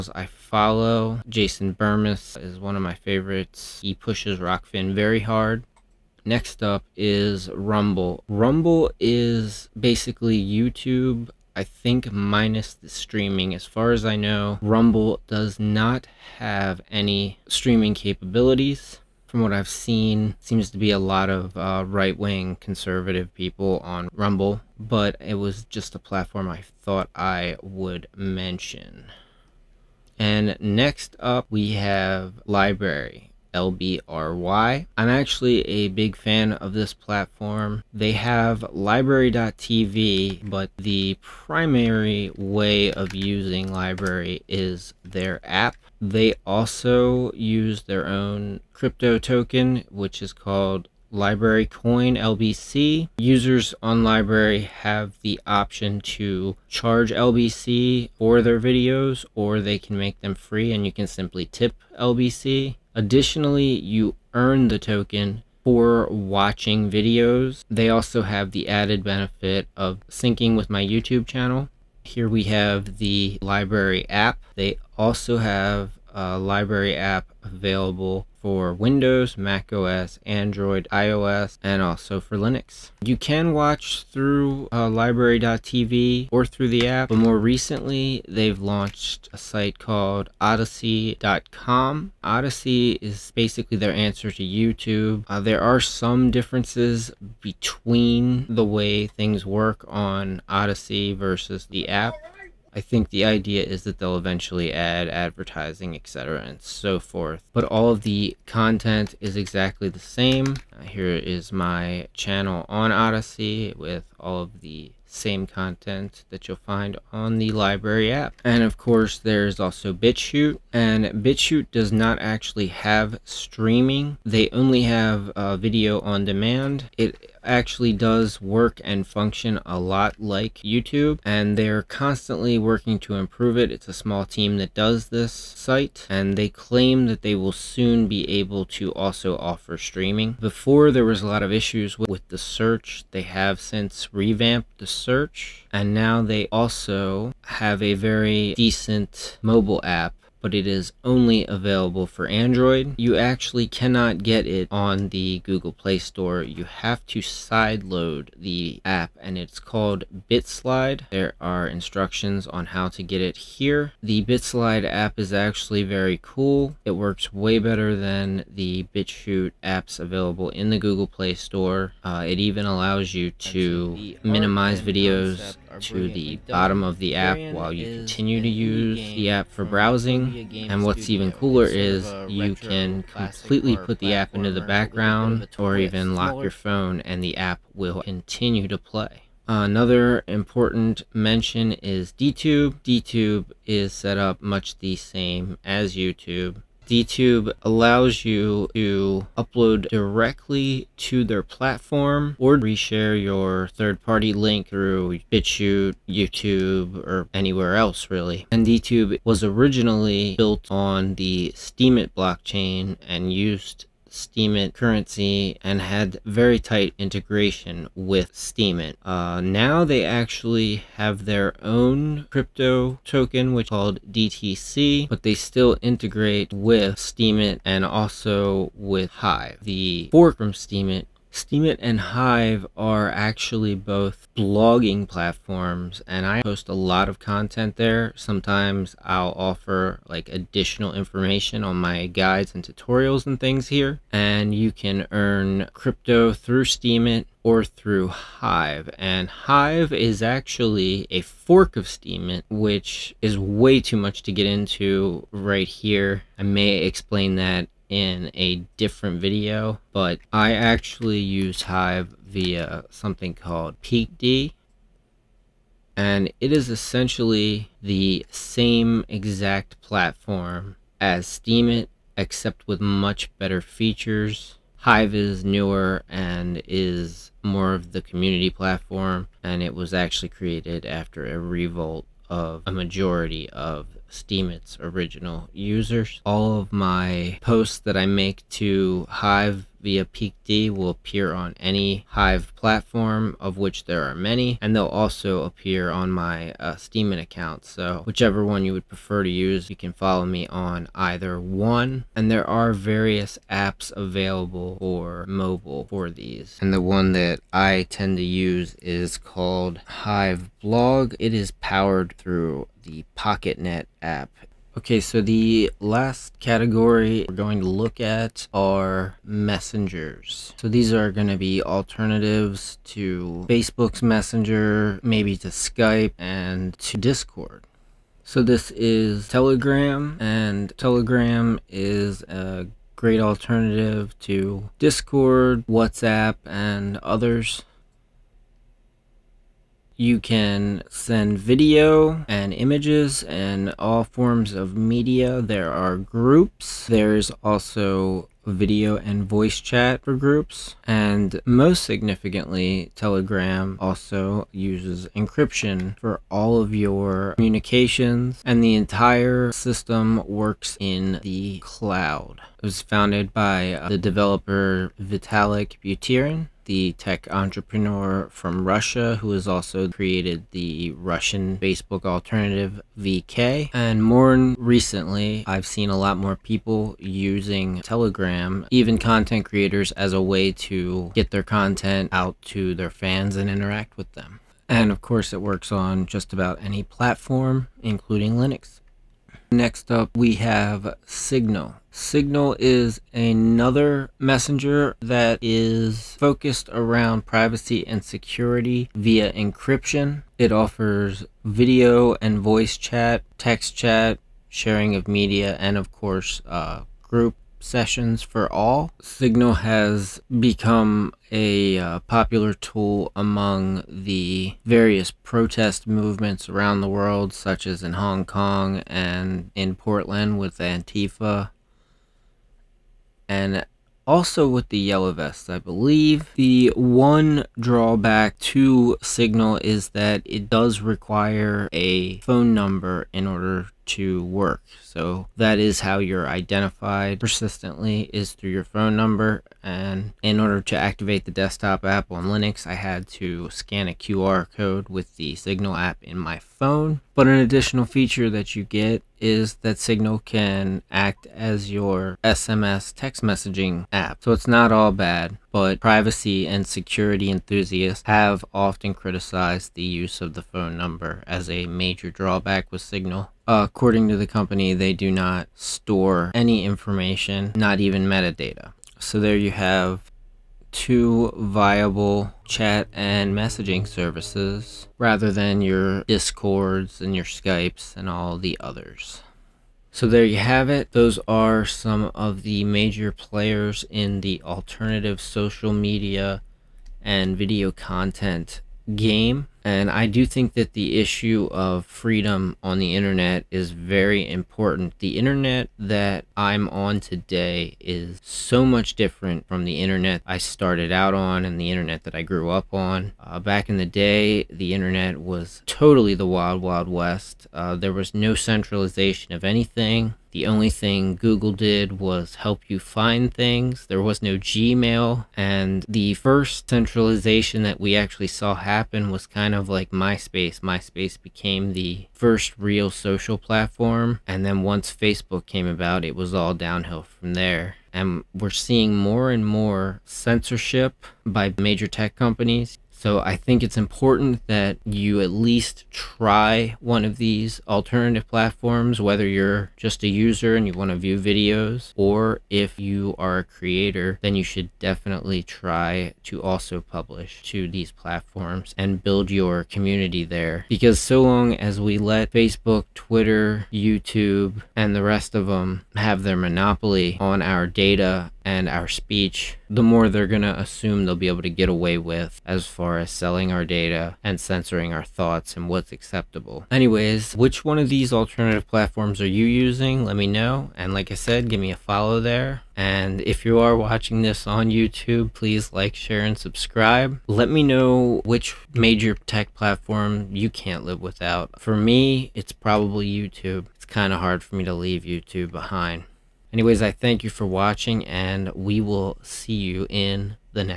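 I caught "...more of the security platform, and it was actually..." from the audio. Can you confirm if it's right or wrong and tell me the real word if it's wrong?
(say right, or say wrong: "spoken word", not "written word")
wrong: "community", not "security".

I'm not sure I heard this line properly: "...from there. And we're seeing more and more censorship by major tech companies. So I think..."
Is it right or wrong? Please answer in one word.
right.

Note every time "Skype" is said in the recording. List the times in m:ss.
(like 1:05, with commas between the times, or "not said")
5:25, 7:57.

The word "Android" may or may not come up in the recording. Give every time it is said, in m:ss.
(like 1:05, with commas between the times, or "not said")
1:20, 2:32.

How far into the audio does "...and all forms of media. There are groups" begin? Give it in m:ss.
5:43.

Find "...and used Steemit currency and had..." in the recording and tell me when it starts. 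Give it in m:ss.
3:33.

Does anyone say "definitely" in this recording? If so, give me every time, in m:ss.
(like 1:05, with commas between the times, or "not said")
9:04.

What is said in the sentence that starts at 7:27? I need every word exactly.
But an additional feature that you get is that Signal can act as your SMS text messaging app.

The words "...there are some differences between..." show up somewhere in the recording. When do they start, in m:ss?
1:35.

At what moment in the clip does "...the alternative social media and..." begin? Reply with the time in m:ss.
8:04.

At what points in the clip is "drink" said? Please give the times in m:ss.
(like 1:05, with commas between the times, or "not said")
not said.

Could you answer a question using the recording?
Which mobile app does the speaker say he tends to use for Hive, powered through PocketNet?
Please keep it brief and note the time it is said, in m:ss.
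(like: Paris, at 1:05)
Hive Blog, at 5:09.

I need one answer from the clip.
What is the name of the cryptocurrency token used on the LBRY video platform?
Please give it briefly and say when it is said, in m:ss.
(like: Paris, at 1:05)
LBRY Coin, at 0:51.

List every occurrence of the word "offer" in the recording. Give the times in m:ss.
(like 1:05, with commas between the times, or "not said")
2:19, 3:59, 6:40.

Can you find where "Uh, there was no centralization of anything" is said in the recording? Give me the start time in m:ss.
8:27.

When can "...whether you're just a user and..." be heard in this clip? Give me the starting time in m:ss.
8:59.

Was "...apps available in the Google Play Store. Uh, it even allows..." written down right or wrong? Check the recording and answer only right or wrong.
right.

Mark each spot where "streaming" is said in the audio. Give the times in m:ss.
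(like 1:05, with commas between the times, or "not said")
0:12, 0:17, 2:03, 2:19.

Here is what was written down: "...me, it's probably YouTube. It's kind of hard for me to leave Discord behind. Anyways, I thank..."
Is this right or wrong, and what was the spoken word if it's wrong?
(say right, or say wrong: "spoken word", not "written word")
wrong: "YouTube", not "Discord".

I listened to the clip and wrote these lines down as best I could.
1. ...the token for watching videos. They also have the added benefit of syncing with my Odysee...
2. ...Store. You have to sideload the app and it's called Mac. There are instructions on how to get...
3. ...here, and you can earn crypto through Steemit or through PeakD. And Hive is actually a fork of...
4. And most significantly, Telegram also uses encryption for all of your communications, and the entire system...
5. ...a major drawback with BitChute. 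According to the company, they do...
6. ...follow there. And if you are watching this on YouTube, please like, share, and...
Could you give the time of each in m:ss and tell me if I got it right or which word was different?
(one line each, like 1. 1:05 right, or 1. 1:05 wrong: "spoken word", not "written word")
1. 1:04 wrong: "YouTube", not "Odysee"
2. 2:35 wrong: "BitSlide", not "Mac"
3. 4:03 wrong: "Hive", not "PeakD"
4. 5:50 right
5. 7:41 wrong: "Signal", not "BitChute"
6. 9:31 right.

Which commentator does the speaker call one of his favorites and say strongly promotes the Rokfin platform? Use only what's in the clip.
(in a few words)
Jason Bermas.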